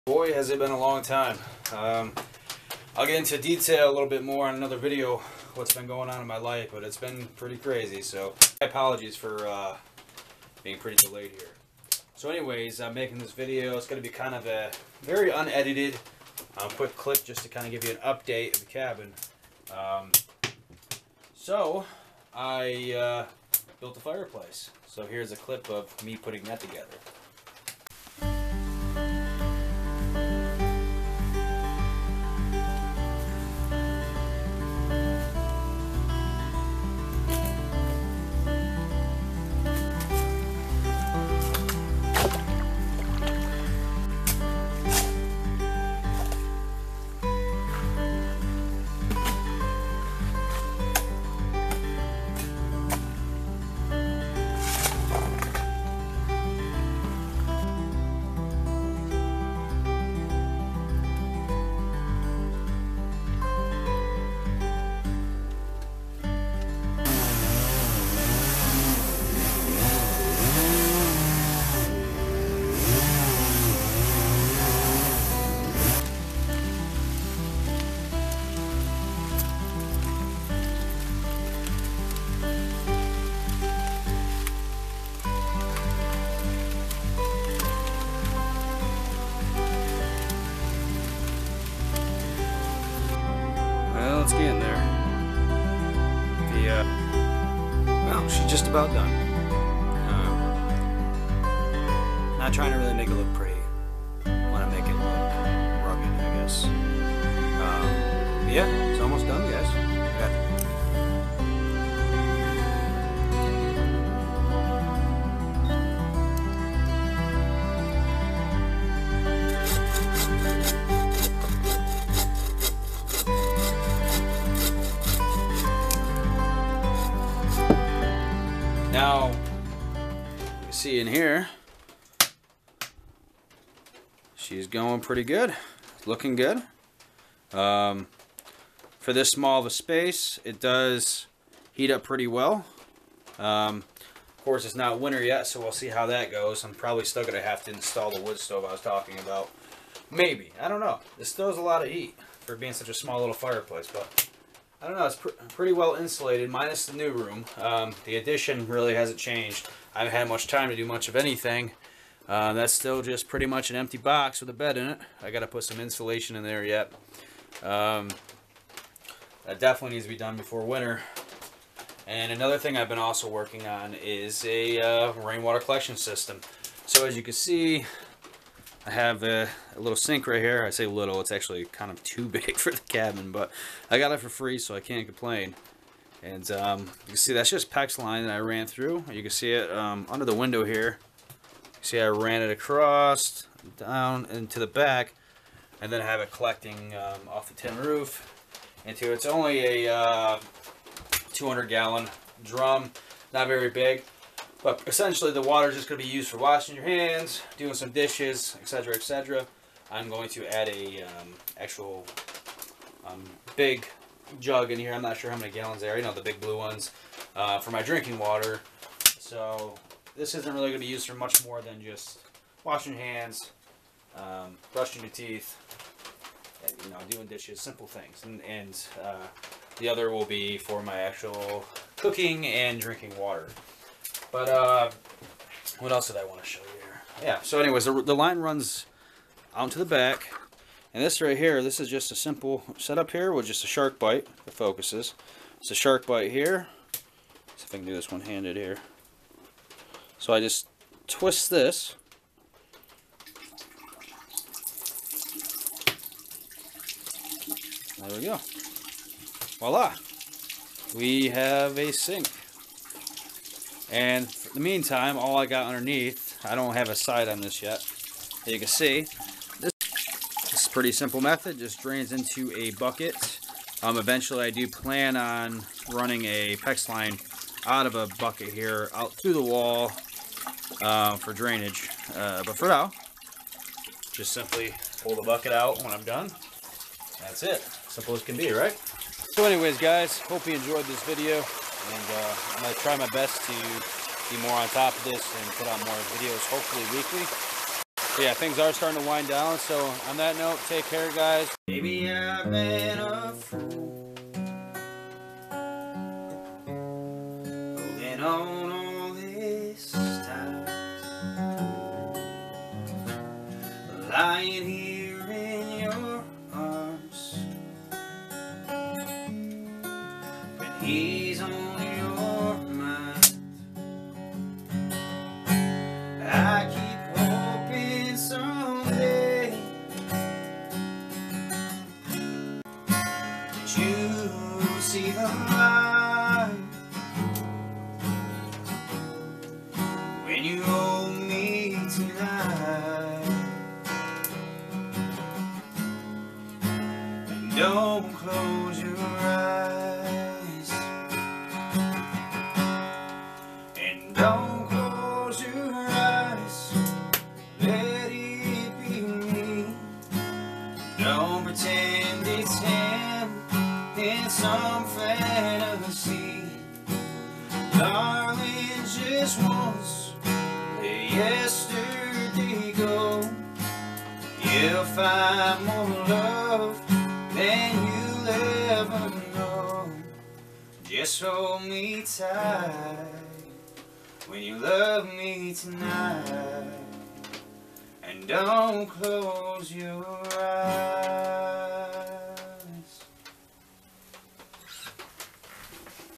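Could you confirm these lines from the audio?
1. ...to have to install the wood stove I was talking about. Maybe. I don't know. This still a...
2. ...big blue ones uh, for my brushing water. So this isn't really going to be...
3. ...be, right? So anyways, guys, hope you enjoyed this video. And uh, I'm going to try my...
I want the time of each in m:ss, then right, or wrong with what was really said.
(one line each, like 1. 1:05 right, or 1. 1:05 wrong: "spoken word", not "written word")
1. 2:27 right
2. 3:36 wrong: "drinking", not "brushing"
3. 4:48 right.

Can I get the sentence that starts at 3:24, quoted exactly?
But essentially the water is just going to be used for washing your hands, doing some dishes, etc., etc.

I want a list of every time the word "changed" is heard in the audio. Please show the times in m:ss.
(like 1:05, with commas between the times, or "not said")
2:39.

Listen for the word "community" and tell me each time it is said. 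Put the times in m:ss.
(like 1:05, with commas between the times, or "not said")
not said.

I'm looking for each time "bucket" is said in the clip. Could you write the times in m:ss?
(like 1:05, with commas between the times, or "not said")
4:32, 4:38, 4:45.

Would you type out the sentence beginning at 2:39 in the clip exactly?
I haven't had much time to do much of anything.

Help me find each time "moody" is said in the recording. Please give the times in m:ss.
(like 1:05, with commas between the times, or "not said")
not said.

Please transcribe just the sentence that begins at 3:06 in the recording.
And um, you can see that's just PEX line that I ran through.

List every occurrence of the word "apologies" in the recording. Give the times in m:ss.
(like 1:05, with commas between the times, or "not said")
0:08.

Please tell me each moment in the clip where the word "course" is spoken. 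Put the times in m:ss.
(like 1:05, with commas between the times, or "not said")
2:24.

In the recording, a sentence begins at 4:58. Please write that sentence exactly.
But yeah, things are starting to wind down.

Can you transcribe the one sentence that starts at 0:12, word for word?
So anyways, I'm making this video.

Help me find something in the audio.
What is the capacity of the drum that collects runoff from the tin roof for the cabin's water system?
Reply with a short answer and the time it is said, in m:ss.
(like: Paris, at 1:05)
200 gallons, at 3:21.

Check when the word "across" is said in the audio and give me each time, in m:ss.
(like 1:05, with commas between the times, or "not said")
3:12.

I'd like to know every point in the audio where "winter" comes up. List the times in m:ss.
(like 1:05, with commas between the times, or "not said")
2:24, 2:50.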